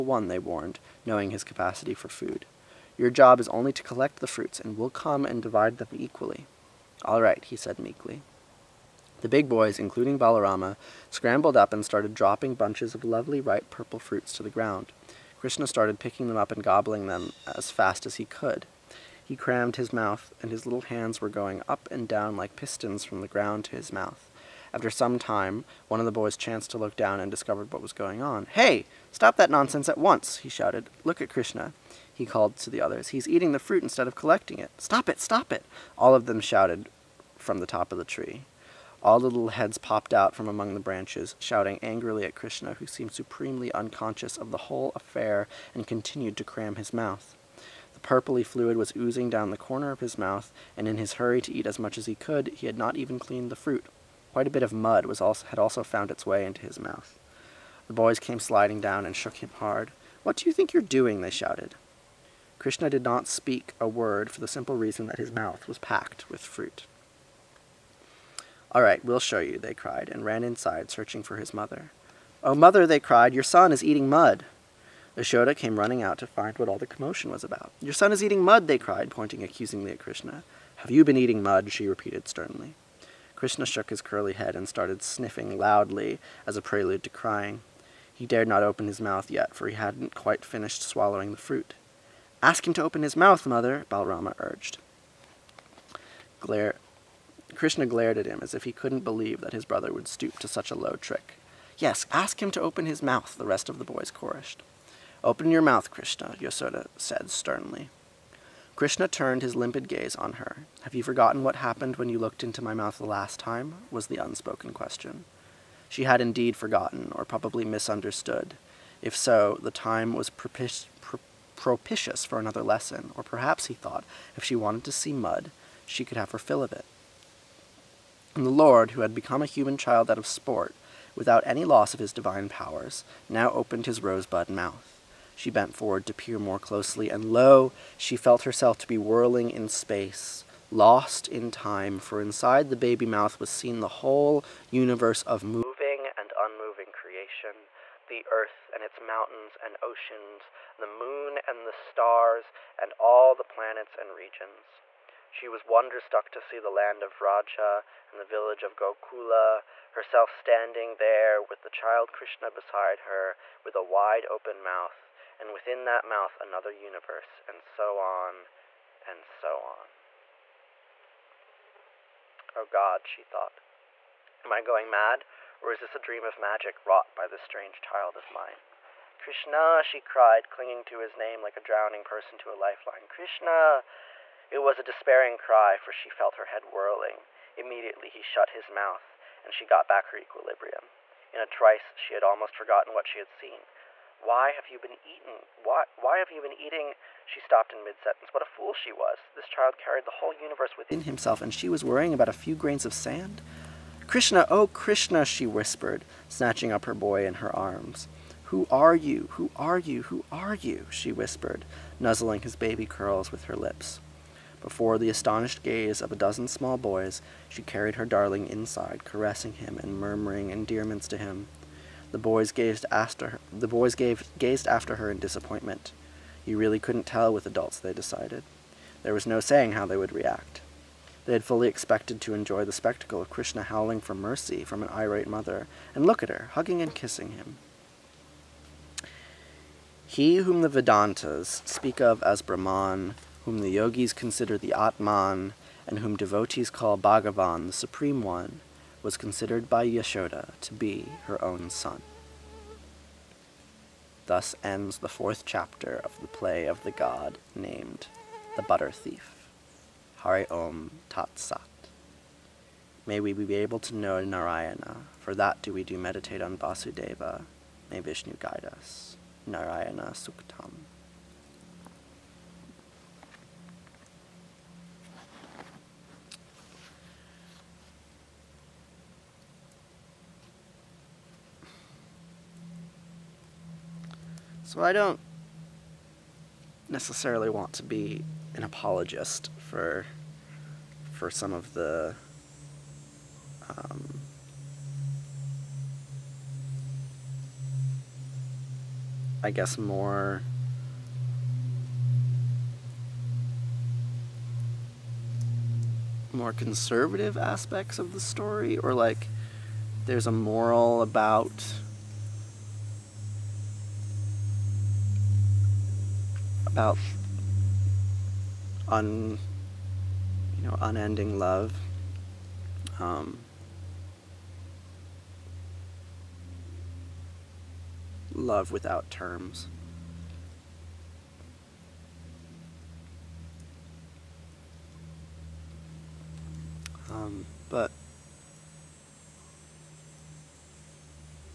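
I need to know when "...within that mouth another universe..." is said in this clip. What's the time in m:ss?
2:45.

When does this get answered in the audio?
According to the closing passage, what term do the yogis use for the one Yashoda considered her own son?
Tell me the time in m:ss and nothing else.
4:04.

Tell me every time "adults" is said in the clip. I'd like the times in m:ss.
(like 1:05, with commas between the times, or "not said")
3:47.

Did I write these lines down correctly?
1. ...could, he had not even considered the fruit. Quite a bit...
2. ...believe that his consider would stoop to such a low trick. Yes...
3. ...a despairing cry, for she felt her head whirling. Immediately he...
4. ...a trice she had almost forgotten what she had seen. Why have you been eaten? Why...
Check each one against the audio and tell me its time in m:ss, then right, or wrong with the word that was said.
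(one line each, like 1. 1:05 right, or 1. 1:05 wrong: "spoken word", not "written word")
1. 0:52 wrong: "cleaned", not "considered"
2. 1:39 wrong: "brother", not "consider"
3. 3:04 right
4. 3:11 right.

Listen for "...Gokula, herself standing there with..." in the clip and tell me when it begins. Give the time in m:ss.
2:38.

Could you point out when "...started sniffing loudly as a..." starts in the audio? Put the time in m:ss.
1:24.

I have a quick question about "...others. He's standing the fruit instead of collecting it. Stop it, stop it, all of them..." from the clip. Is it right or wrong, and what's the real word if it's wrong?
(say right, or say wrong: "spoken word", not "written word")
wrong: "eating", not "standing".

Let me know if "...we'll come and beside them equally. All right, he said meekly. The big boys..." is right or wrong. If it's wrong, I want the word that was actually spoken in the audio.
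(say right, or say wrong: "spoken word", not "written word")
wrong: "divide", not "beside".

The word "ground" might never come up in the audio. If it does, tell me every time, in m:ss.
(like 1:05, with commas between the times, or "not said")
0:14, 0:23.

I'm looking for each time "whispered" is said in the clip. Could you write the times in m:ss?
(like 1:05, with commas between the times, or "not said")
3:25, 3:31.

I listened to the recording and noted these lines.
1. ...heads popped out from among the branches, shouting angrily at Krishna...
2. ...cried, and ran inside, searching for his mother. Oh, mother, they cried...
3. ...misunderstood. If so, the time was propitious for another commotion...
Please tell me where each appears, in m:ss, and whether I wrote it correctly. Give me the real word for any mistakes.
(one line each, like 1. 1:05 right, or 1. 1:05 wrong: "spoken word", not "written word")
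1. 0:39 right
2. 1:09 right
3. 1:57 wrong: "lesson", not "commotion".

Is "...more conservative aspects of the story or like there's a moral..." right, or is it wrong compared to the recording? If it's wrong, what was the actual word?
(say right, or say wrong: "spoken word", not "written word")
right.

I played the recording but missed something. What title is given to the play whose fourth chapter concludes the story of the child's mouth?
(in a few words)
The Butter Thief.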